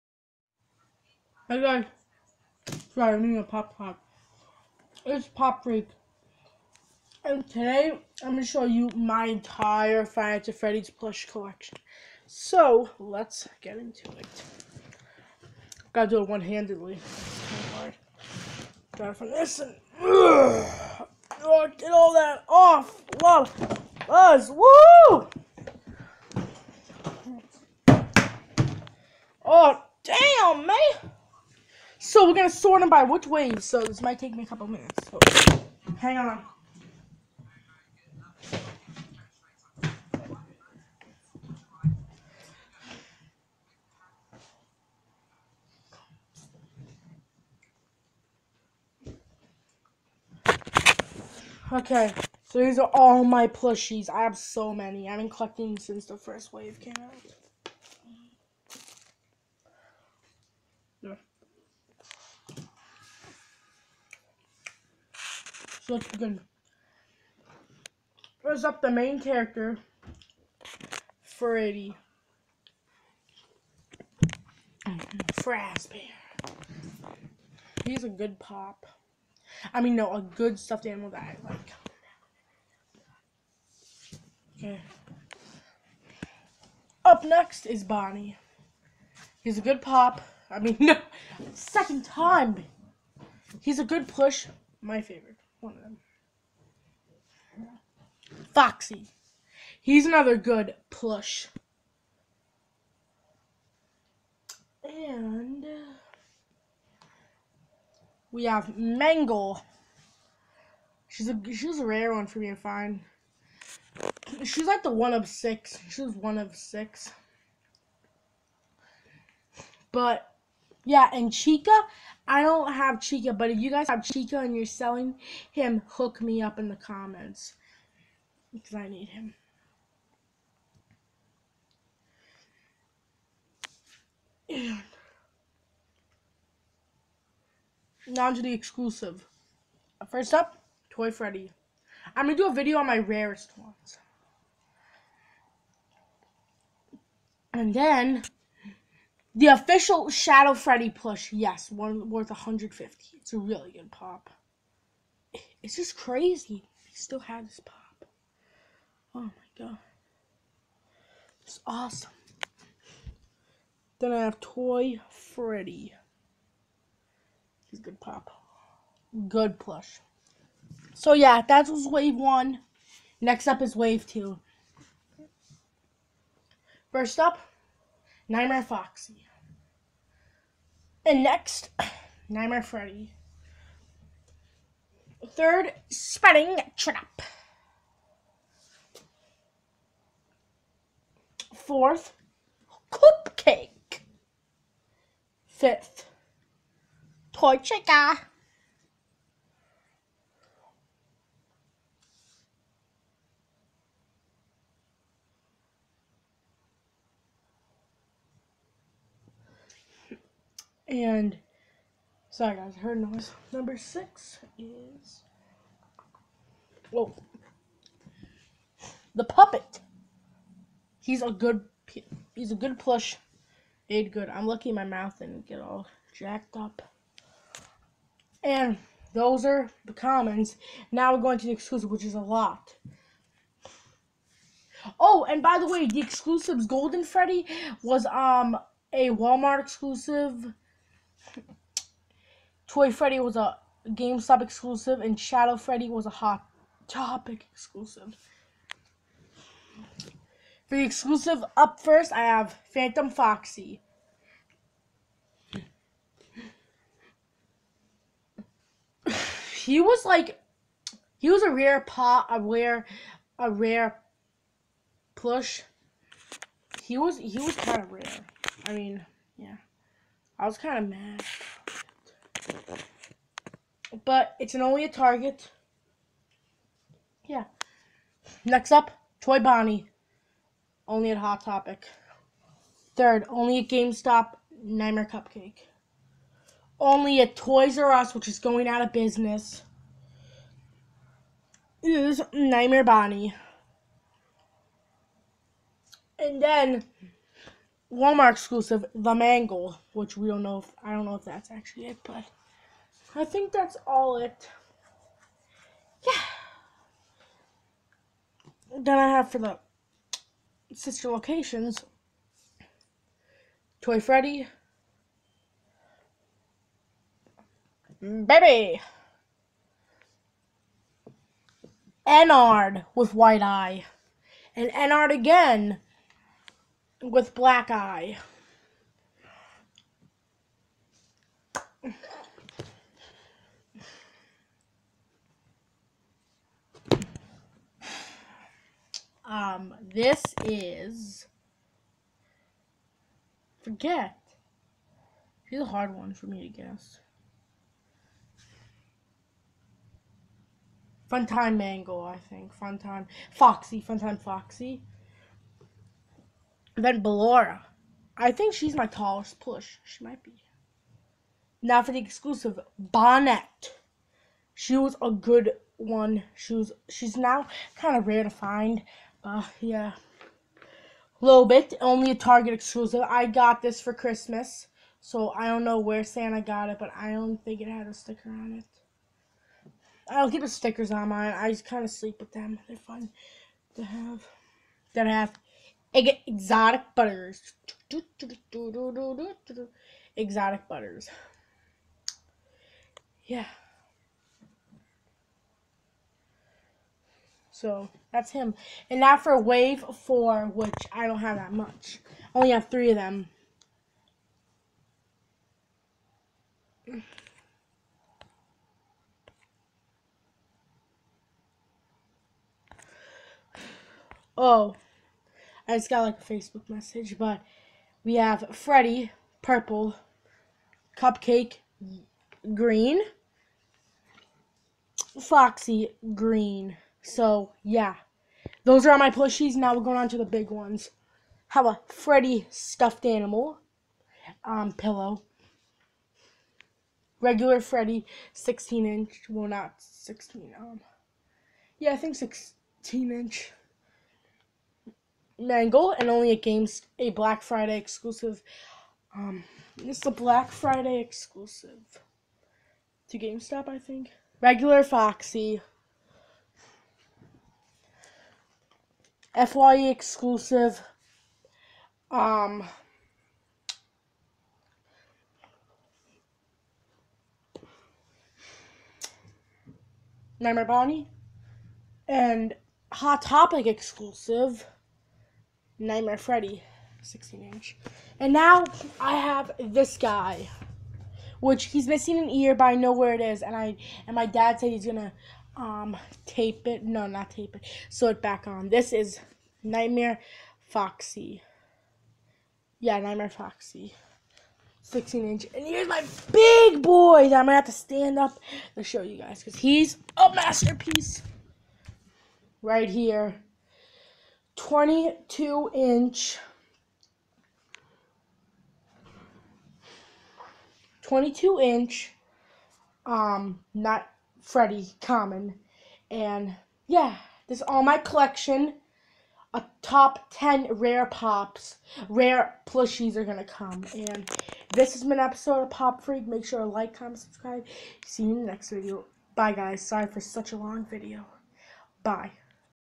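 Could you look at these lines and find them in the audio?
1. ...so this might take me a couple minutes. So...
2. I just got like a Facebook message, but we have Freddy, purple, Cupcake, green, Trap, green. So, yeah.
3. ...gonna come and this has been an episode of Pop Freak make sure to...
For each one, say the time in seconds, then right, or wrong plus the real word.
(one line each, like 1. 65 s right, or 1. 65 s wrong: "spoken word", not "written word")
1. 33 s right
2. 415 s wrong: "Foxy", not "Trap"
3. 523 s right.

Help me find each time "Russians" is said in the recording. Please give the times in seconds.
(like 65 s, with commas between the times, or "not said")
not said.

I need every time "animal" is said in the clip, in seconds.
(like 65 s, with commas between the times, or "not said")
80 s, 433 s.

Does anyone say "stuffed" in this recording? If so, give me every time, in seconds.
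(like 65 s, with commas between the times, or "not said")
80 s, 432 s.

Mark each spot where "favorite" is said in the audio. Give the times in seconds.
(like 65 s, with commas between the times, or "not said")
95 s.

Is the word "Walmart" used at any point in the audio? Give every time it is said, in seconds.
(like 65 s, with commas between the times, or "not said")
239 s, 297 s.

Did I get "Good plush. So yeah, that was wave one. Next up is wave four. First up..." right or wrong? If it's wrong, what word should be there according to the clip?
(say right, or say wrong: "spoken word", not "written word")
wrong: "two", not "four".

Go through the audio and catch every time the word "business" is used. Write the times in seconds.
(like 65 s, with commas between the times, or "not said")
288 s.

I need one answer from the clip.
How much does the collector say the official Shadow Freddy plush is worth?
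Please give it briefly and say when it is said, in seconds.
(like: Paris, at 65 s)
150, at 152 s.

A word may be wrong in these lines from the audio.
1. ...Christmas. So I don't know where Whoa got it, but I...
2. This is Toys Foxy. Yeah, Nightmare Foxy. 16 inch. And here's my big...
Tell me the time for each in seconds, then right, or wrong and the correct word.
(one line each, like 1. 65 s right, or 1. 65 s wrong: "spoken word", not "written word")
1. 373 s wrong: "Santa", not "Whoa"
2. 488 s wrong: "Nightmare", not "Toys".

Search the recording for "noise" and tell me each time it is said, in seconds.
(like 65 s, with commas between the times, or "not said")
212 s.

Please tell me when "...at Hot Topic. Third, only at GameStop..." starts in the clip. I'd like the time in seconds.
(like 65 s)
281 s.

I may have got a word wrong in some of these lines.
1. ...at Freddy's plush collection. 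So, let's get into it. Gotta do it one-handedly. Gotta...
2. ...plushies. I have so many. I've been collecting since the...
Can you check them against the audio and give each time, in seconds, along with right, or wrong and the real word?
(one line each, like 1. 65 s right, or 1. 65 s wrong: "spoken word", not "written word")
1. 10 s right
2. 53 s right.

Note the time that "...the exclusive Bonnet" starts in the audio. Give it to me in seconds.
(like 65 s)
361 s.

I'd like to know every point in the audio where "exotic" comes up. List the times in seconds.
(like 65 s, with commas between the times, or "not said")
385 s, 390 s.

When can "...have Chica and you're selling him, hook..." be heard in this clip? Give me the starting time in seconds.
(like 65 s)
123 s.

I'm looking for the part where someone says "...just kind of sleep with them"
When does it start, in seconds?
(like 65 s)
381 s.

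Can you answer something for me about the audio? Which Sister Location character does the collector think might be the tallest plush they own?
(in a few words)
Ballora.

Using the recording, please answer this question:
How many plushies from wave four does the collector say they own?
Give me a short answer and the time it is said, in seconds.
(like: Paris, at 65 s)
3, at 402 s.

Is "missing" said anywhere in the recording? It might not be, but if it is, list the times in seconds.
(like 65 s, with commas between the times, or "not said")
481 s.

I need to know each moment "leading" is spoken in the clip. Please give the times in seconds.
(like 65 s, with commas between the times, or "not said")
not said.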